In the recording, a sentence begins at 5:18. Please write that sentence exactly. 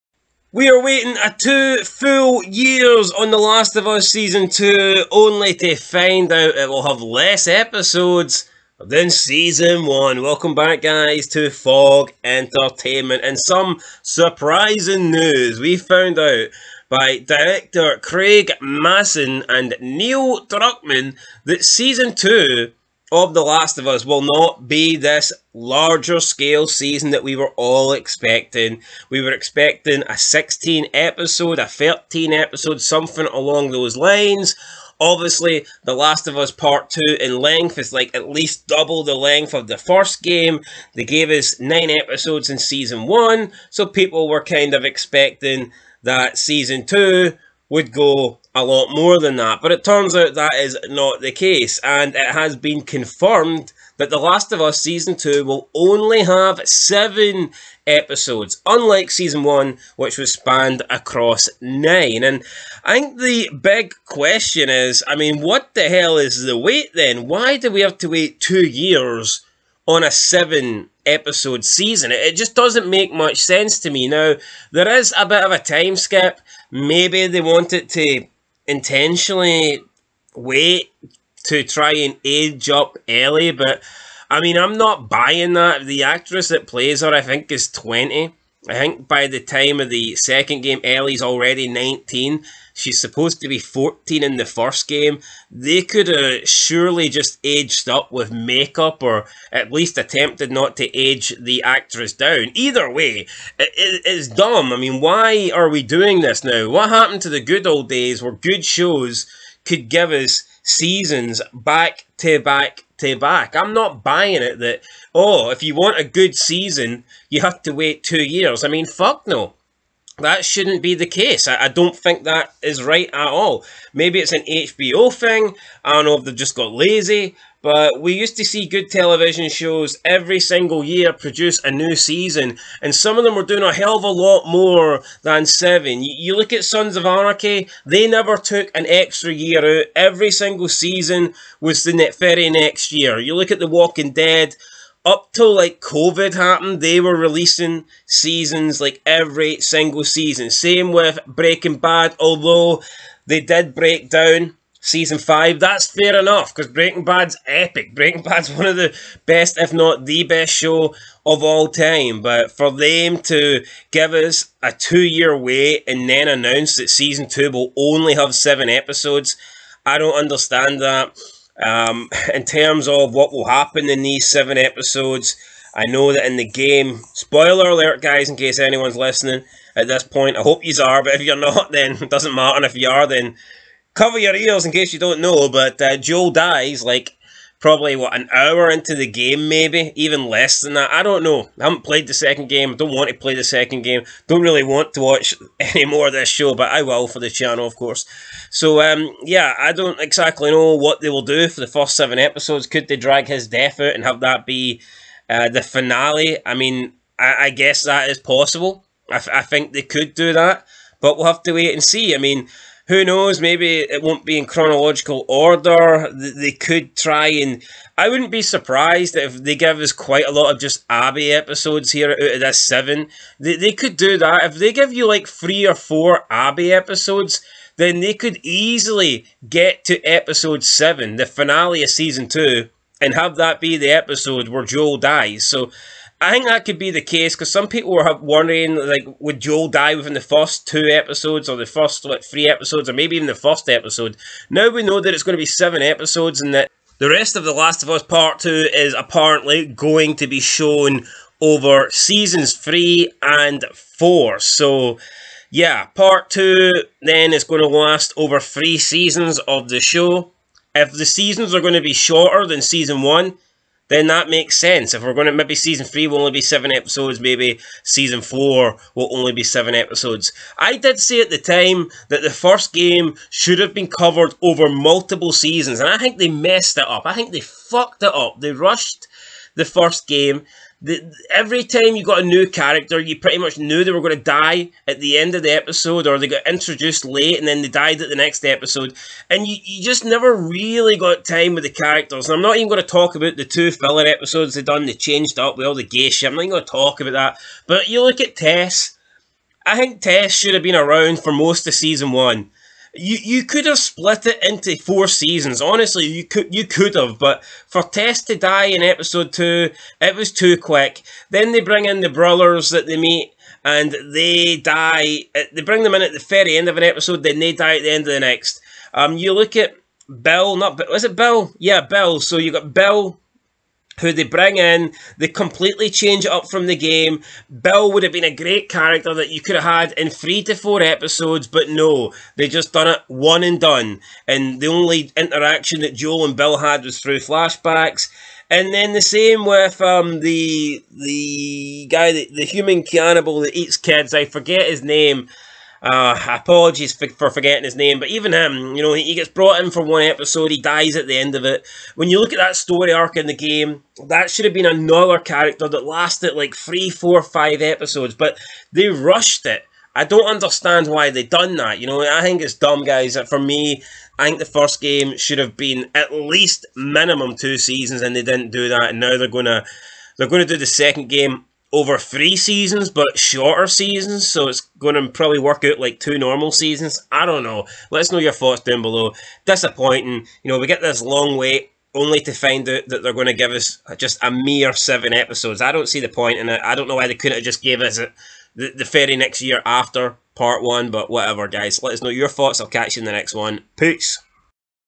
Um, you look at Bill, not was it Bill?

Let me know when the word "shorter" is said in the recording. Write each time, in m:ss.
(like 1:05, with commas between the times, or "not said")
4:21, 6:13.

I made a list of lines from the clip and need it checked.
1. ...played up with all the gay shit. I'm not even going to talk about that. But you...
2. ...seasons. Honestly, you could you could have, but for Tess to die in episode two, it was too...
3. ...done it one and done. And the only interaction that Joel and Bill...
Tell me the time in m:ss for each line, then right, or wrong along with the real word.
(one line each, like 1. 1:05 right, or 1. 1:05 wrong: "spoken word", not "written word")
1. 4:54 wrong: "changed", not "played"
2. 5:05 right
3. 5:32 right.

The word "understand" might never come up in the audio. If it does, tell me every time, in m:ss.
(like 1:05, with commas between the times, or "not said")
2:50, 6:00.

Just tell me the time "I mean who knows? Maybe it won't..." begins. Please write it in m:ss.
3:32.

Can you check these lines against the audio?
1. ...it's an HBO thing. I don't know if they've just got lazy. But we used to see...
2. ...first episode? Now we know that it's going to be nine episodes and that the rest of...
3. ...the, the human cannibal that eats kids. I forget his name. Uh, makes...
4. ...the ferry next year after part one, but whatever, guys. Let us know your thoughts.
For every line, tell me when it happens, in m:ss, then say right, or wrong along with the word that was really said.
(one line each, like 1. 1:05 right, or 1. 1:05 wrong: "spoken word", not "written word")
1. 2:04 right
2. 4:03 wrong: "seven", not "nine"
3. 5:42 wrong: "apologies", not "makes"
4. 6:28 right.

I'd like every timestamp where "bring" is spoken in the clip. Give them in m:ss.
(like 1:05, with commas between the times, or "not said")
5:11, 5:15, 5:24.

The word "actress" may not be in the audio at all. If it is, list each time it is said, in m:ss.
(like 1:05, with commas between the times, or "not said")
1:26, 1:41.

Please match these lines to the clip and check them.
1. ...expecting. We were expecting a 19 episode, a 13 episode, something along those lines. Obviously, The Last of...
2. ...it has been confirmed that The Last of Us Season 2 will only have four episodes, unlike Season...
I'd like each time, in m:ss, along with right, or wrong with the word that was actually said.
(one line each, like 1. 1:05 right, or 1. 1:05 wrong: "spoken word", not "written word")
1. 0:27 wrong: "16", not "19"
2. 0:52 wrong: "seven", not "four".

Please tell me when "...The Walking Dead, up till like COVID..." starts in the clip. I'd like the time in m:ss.
2:23.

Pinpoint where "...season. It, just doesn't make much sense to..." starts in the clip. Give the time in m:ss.
1:11.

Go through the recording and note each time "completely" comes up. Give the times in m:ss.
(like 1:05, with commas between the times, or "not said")
5:25.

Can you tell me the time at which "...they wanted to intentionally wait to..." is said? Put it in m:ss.
1:17.